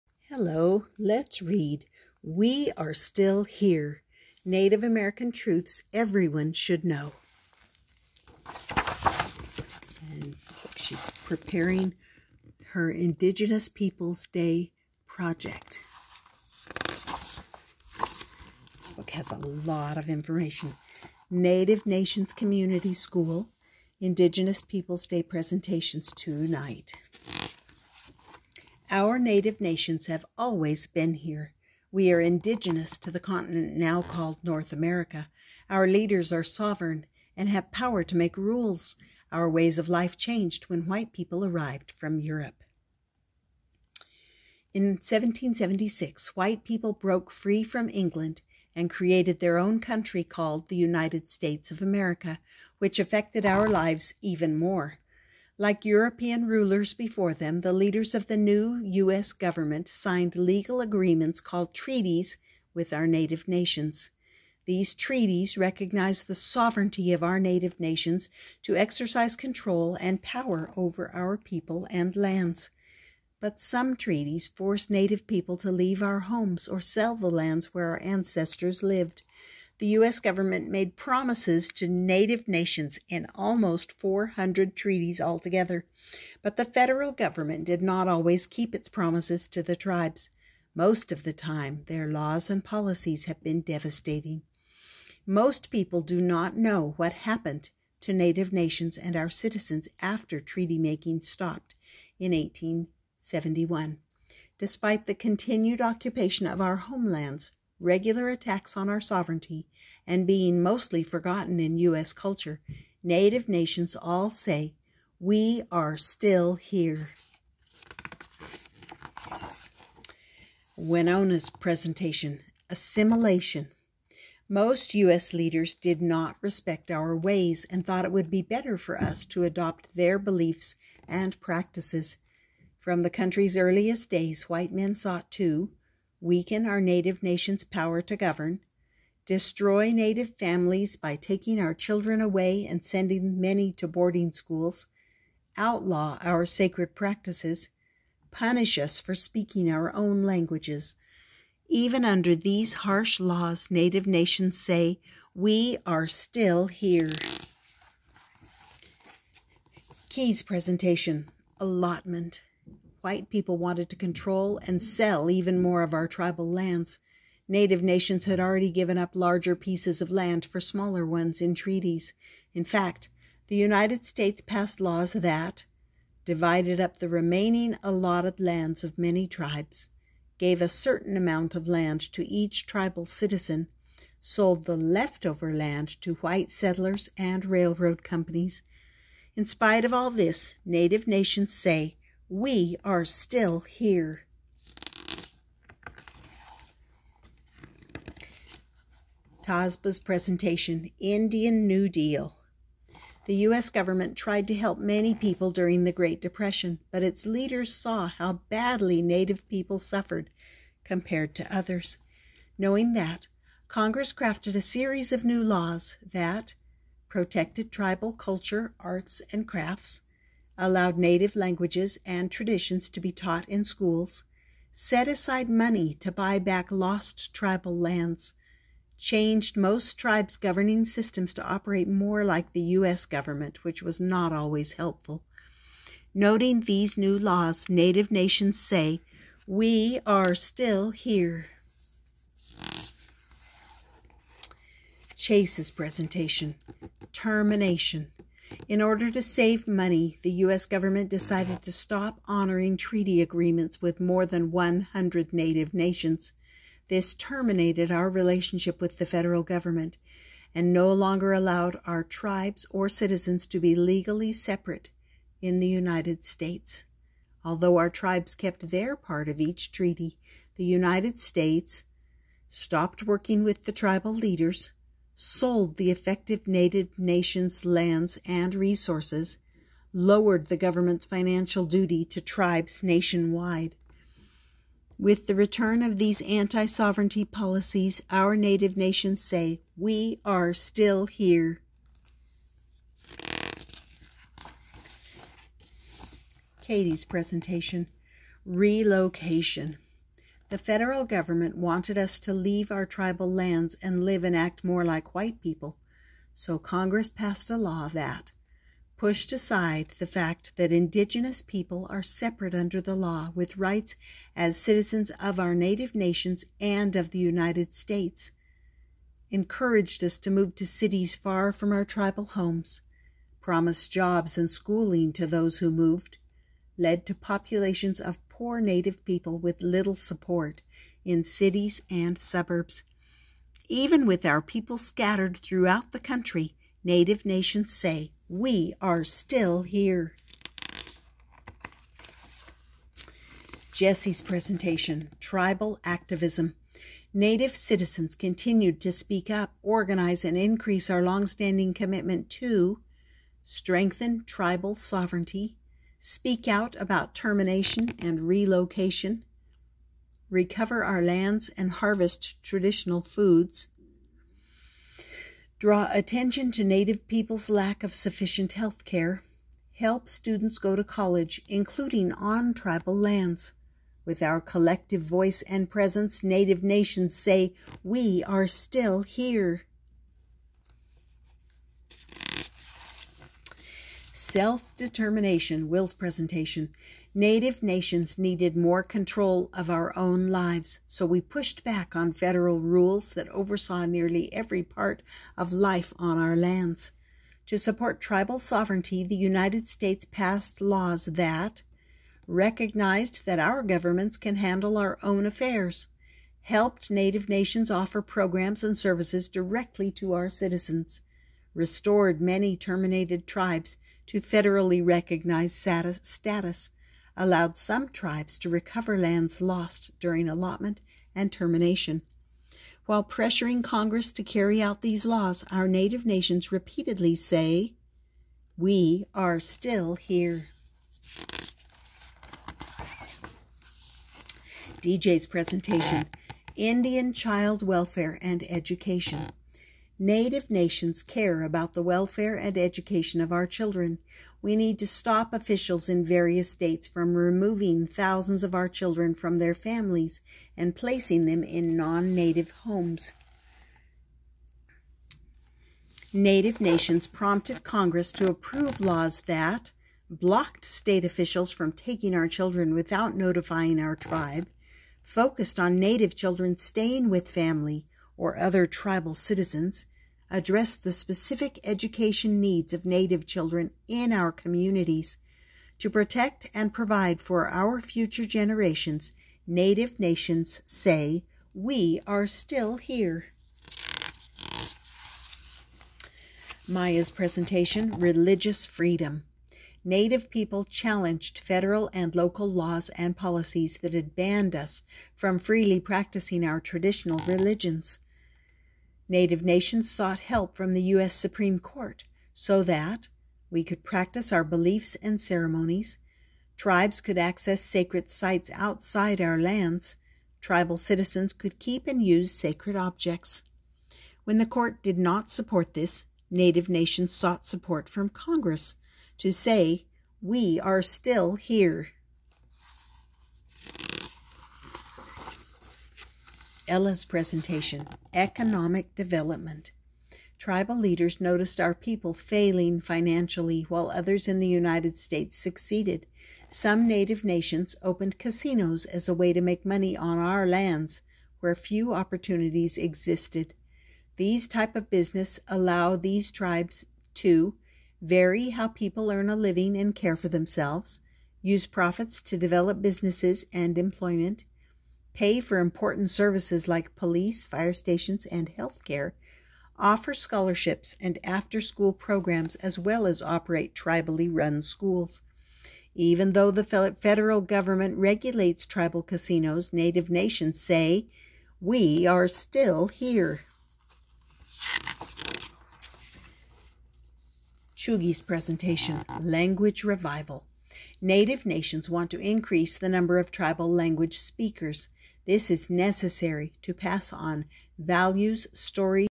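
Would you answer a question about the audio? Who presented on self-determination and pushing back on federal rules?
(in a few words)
Will.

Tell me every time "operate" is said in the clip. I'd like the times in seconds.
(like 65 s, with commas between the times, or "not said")
231 s, 563 s.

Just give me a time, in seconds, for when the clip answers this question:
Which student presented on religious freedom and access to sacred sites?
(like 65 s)
486 s.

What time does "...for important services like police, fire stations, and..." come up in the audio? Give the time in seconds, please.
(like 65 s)
555 s.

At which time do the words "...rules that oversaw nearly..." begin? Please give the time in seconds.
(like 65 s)
392 s.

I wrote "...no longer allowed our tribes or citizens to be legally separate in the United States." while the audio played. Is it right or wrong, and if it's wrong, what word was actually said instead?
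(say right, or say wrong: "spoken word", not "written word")
right.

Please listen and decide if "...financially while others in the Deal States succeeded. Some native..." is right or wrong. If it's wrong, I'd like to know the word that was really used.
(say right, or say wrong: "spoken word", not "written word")
wrong: "United", not "Deal".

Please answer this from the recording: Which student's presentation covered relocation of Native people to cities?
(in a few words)
Katie.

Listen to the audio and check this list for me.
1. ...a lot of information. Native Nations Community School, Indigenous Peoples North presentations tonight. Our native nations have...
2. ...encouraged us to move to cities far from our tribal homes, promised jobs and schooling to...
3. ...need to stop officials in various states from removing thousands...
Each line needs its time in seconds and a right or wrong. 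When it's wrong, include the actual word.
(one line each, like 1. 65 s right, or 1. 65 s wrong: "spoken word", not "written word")
1. 19 s wrong: "Day", not "North"
2. 319 s right
3. 444 s right.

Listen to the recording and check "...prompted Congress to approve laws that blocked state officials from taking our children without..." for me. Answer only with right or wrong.
right.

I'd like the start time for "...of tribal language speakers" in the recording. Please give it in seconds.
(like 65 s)
583 s.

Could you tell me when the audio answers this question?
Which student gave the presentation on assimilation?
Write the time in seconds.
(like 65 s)
120 s.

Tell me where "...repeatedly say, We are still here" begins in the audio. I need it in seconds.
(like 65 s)
426 s.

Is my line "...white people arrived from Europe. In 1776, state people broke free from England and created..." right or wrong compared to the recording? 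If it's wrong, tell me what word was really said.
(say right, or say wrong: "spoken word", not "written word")
wrong: "white", not "state".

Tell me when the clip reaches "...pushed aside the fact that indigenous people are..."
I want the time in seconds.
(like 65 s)
308 s.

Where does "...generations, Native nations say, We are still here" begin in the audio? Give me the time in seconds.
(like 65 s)
478 s.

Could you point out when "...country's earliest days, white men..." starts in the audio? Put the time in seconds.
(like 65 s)
133 s.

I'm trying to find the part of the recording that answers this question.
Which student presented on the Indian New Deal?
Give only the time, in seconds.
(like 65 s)
199 s.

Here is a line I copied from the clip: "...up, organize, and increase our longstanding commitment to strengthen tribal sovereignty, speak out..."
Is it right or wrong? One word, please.
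right.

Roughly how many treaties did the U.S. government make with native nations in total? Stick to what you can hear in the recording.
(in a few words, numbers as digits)
almost 400.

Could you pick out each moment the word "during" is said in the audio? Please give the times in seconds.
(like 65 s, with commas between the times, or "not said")
205 s, 419 s.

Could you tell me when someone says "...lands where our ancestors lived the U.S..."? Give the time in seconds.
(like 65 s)
77 s.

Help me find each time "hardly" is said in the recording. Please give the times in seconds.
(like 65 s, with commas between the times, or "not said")
not said.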